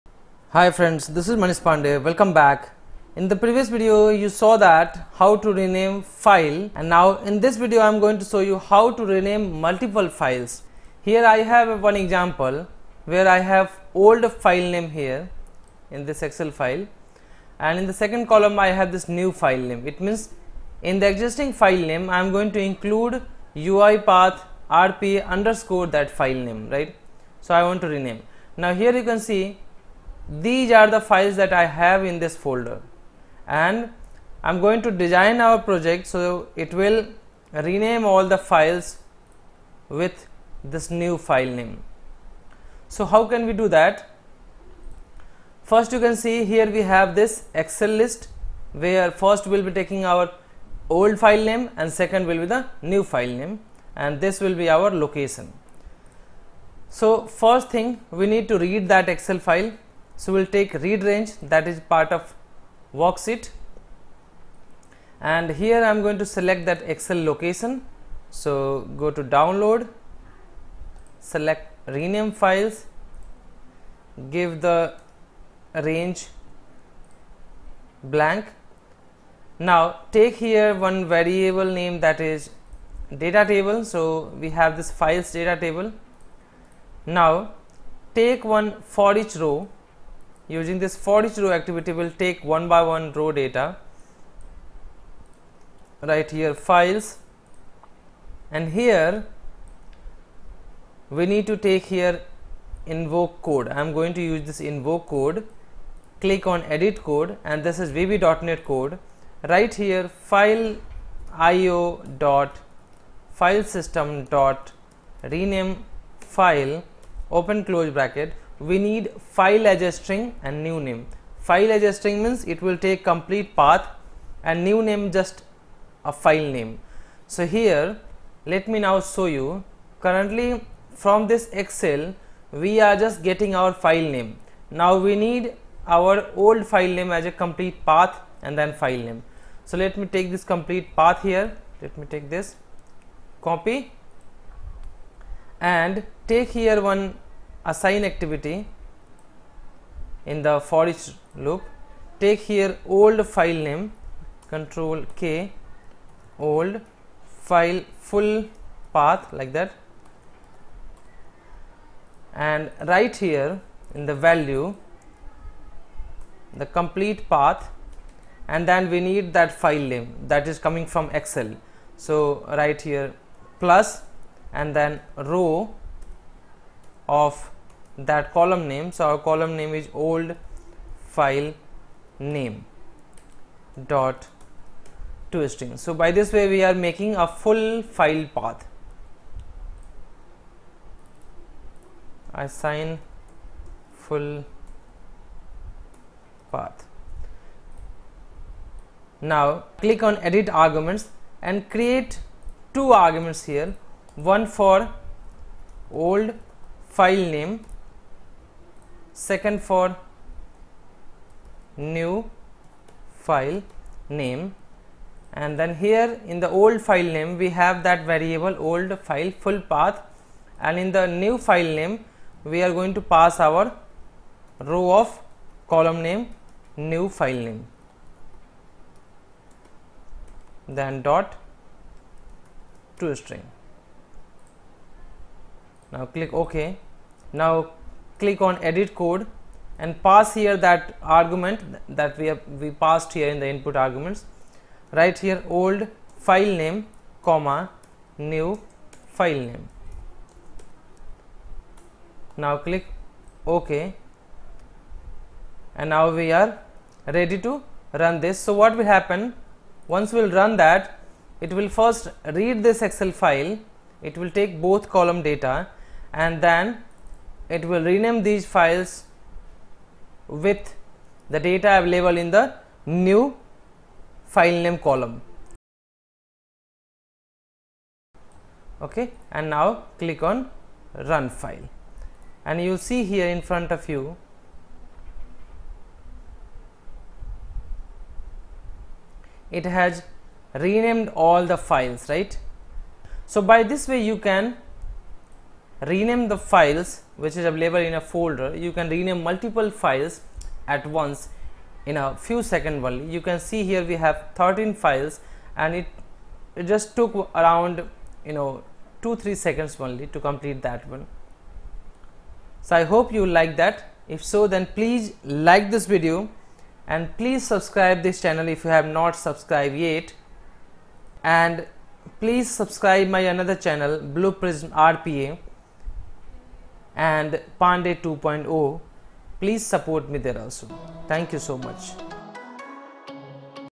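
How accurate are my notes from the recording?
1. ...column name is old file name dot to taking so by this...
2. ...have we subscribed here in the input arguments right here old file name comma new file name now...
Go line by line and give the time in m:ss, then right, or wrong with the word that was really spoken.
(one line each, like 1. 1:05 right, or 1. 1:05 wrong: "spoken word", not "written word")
1. 2:59 wrong: "string", not "taking"
2. 4:02 wrong: "passed", not "subscribed".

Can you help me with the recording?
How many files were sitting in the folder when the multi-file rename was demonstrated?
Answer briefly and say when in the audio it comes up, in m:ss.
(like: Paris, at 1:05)
13, at 5:04.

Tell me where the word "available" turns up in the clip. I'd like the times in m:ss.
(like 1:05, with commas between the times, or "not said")
4:31, 4:57.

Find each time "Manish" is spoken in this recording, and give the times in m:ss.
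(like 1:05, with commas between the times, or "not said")
0:01.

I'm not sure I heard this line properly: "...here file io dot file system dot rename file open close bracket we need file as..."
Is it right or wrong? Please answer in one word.
right.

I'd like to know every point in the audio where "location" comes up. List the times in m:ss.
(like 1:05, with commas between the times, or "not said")
0:54, 1:07.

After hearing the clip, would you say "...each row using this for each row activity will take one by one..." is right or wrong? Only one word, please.
right.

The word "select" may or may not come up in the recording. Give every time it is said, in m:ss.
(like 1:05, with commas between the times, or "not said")
1:06, 1:11.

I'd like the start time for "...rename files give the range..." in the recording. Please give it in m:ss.
1:11.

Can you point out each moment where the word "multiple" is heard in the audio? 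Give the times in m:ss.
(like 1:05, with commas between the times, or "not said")
0:09, 4:59.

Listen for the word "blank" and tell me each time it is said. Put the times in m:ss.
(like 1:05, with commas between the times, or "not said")
1:18.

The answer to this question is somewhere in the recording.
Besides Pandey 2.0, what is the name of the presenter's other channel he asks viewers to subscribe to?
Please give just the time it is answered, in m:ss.
5:23.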